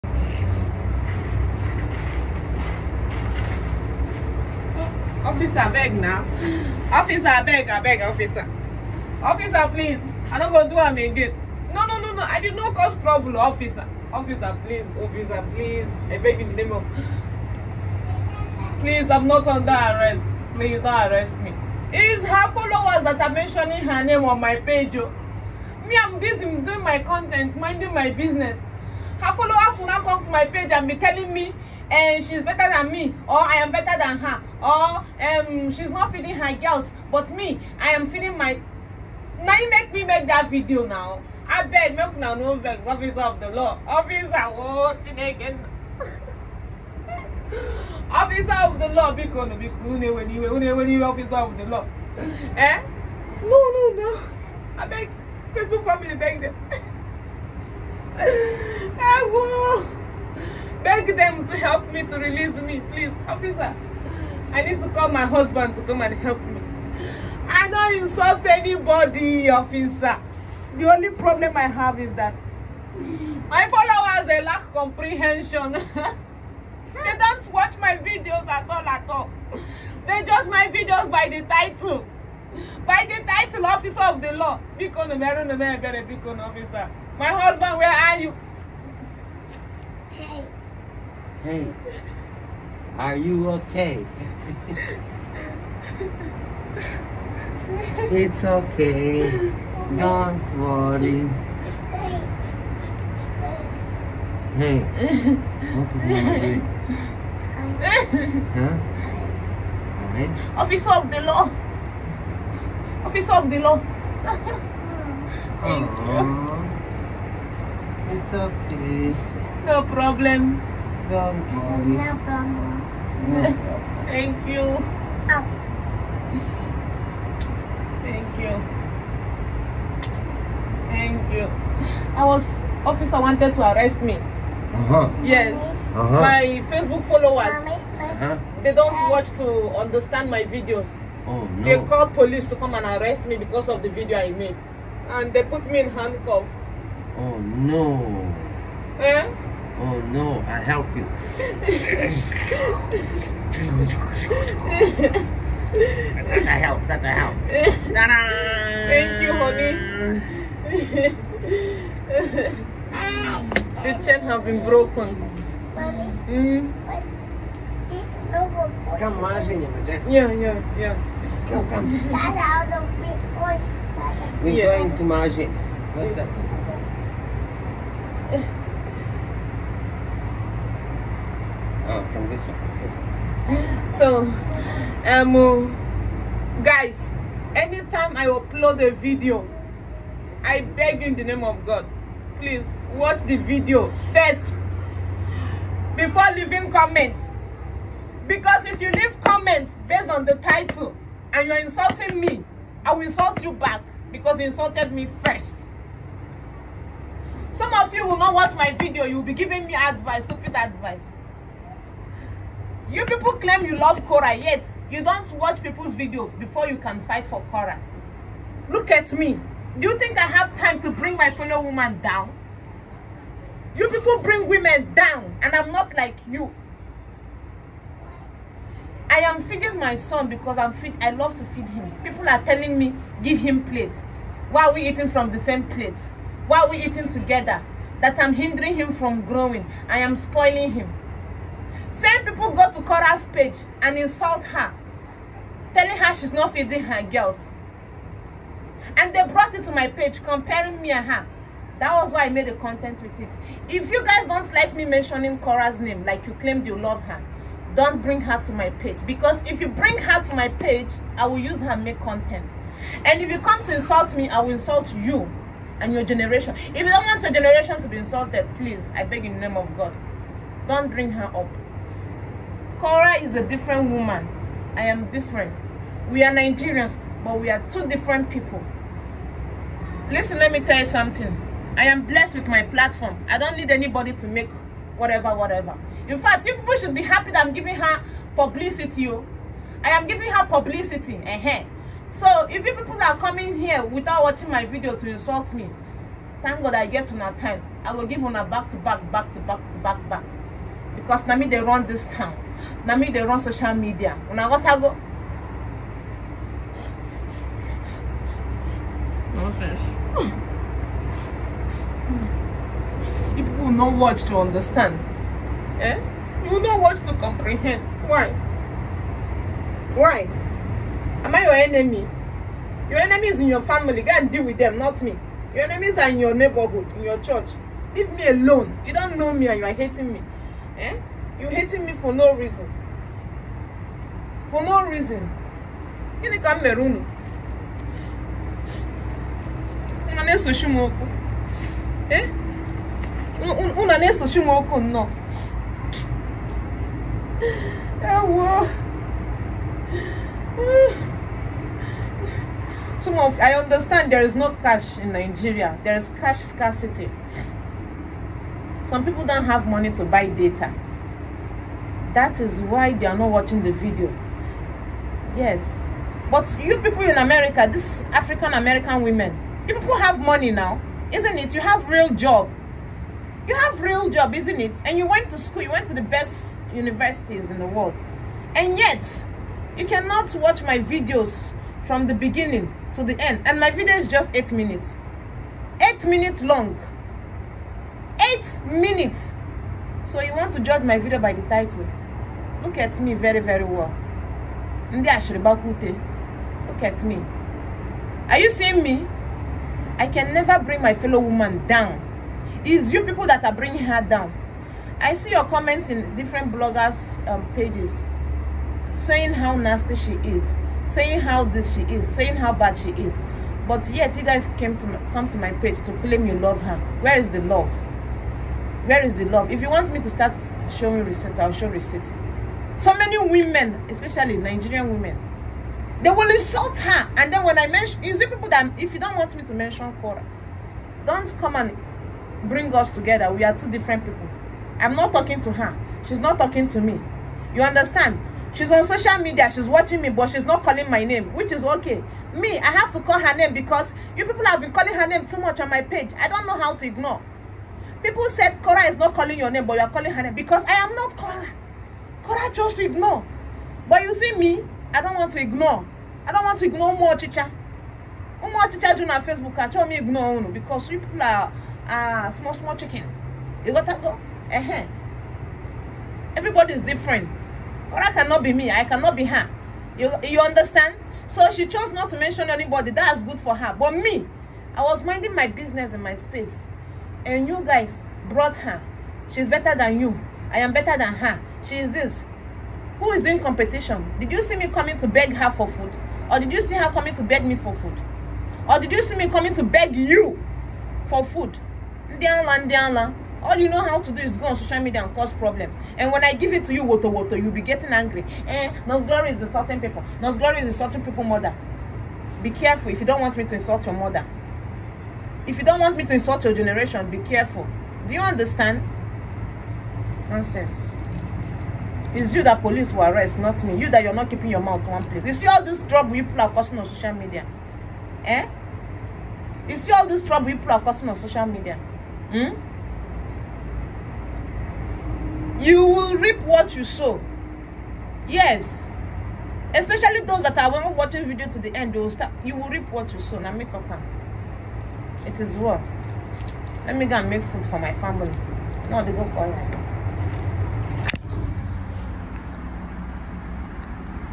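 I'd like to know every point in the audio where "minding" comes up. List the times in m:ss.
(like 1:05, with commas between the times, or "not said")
0:27, 7:55.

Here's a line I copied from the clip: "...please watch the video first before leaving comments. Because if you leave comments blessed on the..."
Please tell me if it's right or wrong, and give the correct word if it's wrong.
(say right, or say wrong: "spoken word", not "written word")
wrong: "based", not "blessed".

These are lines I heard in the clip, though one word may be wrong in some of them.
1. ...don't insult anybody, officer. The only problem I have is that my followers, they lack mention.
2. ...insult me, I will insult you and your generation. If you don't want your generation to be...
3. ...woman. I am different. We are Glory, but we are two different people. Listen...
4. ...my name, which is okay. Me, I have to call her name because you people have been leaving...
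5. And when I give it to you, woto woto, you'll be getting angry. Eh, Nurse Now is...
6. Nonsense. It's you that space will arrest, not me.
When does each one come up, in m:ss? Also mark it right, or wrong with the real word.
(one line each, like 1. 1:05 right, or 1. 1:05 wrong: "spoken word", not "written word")
1. 1:07 wrong: "comprehension", not "mention"
2. 4:23 right
3. 4:33 wrong: "Nigerians", not "Glory"
4. 7:20 wrong: "calling", not "leaving"
5. 8:15 wrong: "Glory", not "Now"
6. 8:30 wrong: "police", not "space".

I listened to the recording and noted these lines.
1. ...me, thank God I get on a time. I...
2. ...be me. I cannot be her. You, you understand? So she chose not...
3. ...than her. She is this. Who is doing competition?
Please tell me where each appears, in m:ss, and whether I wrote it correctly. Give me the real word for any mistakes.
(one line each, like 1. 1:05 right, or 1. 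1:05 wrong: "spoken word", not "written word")
1. 4:55 right
2. 7:48 right
3. 8:00 right.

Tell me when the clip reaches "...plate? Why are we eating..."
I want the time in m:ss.
3:55.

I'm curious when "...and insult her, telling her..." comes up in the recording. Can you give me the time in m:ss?
4:03.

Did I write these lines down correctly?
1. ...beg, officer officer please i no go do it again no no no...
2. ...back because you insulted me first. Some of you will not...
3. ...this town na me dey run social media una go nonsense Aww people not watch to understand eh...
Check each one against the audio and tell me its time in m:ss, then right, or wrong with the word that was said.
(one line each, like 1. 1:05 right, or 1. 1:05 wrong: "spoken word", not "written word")
1. 0:07 right
2. 3:23 right
3. 5:01 wrong: "People", not "Aww".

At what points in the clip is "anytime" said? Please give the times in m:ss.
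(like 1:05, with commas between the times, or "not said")
3:07.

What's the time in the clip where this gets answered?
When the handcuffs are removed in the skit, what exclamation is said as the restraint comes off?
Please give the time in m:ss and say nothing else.
2:37.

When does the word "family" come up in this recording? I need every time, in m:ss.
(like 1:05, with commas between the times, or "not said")
0:55, 5:23, 8:57.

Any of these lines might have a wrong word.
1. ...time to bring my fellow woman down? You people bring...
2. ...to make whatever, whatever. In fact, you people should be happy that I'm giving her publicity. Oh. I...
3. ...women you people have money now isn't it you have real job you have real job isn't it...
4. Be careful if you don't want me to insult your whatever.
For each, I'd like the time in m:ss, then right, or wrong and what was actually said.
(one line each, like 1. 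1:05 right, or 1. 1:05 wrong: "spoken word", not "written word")
1. 3:40 right
2. 4:44 right
3. 6:09 right
4. 8:22 wrong: "mother", not "whatever".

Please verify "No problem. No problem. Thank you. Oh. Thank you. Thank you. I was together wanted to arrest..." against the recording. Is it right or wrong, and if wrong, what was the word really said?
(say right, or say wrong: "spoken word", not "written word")
wrong: "officer", not "together".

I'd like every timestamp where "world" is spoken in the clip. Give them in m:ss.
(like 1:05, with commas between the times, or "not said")
6:17.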